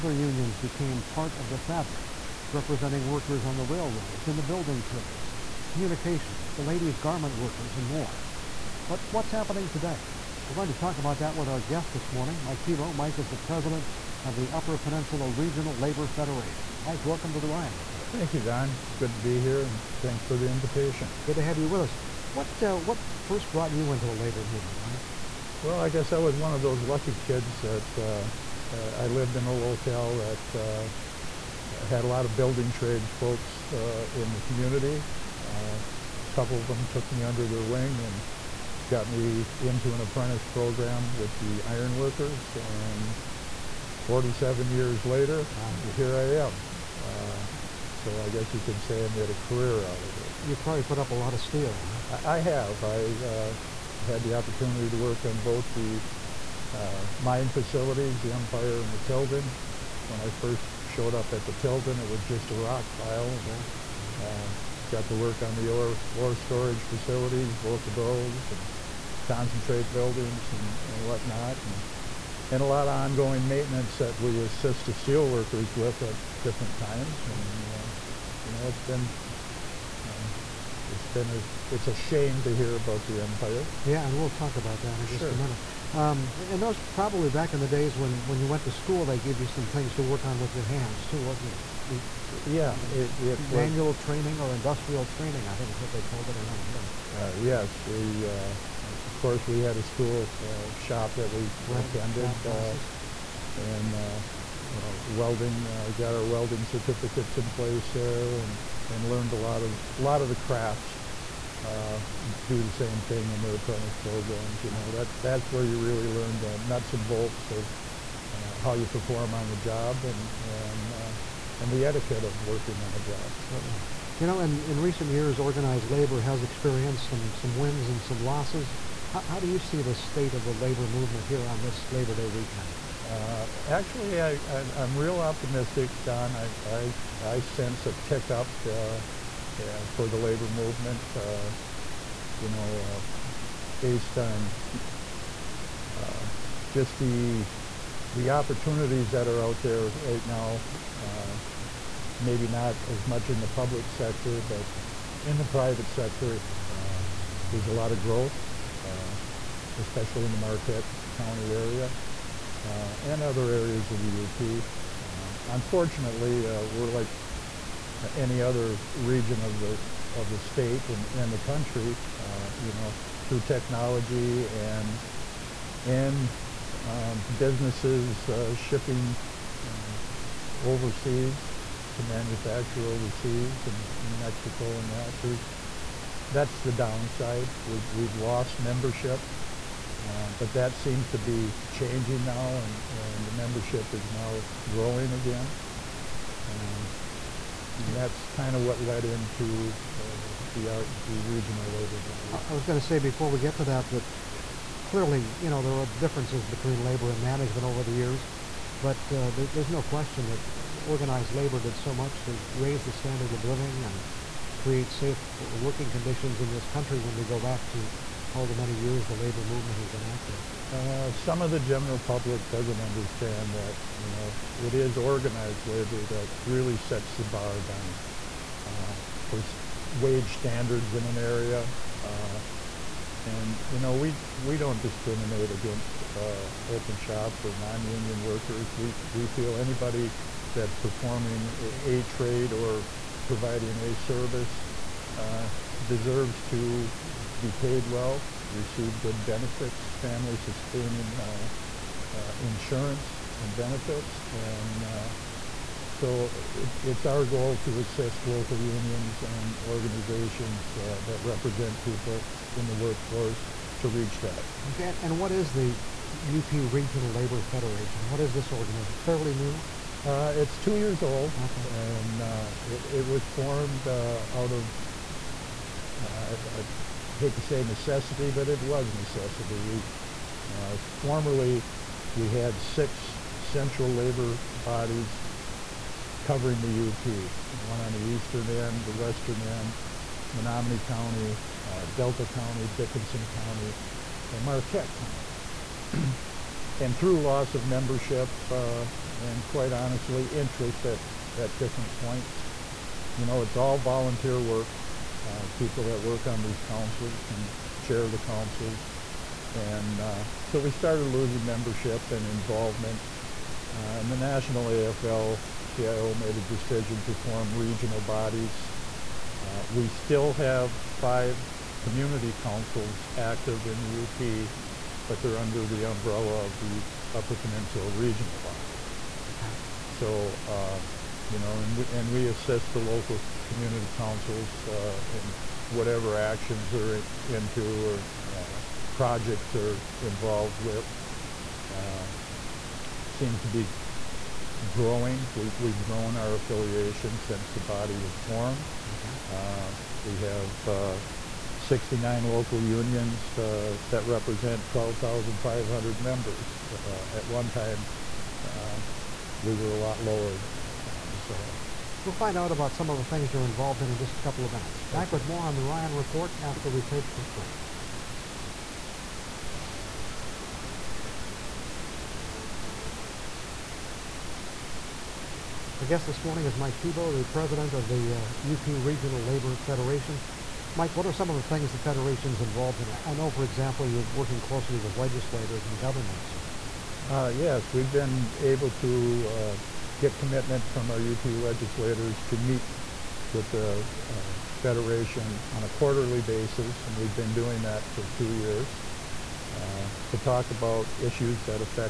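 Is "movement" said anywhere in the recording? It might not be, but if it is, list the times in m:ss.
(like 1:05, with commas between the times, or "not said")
0:24, 2:10, 2:20, 3:39.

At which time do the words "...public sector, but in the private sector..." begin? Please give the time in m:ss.
2:33.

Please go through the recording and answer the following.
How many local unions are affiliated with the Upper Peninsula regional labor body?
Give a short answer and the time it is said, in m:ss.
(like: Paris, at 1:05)
69, at 5:51.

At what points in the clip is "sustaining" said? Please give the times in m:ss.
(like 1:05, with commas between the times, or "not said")
4:10.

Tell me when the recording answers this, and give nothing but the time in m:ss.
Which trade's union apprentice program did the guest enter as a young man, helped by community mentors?
0:41.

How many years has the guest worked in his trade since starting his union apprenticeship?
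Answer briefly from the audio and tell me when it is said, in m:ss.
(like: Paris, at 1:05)
47, at 0:44.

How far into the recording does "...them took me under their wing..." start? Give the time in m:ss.
0:36.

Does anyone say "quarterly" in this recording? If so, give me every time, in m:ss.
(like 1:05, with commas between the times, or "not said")
6:35.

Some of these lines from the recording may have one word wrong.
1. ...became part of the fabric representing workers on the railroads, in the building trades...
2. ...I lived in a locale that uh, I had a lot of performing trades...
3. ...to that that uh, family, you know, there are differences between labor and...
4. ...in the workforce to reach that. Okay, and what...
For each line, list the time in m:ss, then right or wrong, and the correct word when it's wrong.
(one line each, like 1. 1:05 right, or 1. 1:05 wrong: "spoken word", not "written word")
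1. 0:00 right
2. 0:29 wrong: "building", not "performing"
3. 3:23 wrong: "clearly", not "family"
4. 4:22 right.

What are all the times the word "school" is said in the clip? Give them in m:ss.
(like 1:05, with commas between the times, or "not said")
1:28, 1:39.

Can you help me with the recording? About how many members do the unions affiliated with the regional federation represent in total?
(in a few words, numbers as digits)
12,500.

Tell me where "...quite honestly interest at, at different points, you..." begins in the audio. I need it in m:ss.
4:59.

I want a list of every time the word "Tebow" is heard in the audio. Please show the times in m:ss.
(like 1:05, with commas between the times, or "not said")
0:12, 6:16.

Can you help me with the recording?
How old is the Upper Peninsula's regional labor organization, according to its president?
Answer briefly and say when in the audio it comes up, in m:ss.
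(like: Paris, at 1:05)
2 years, at 4:30.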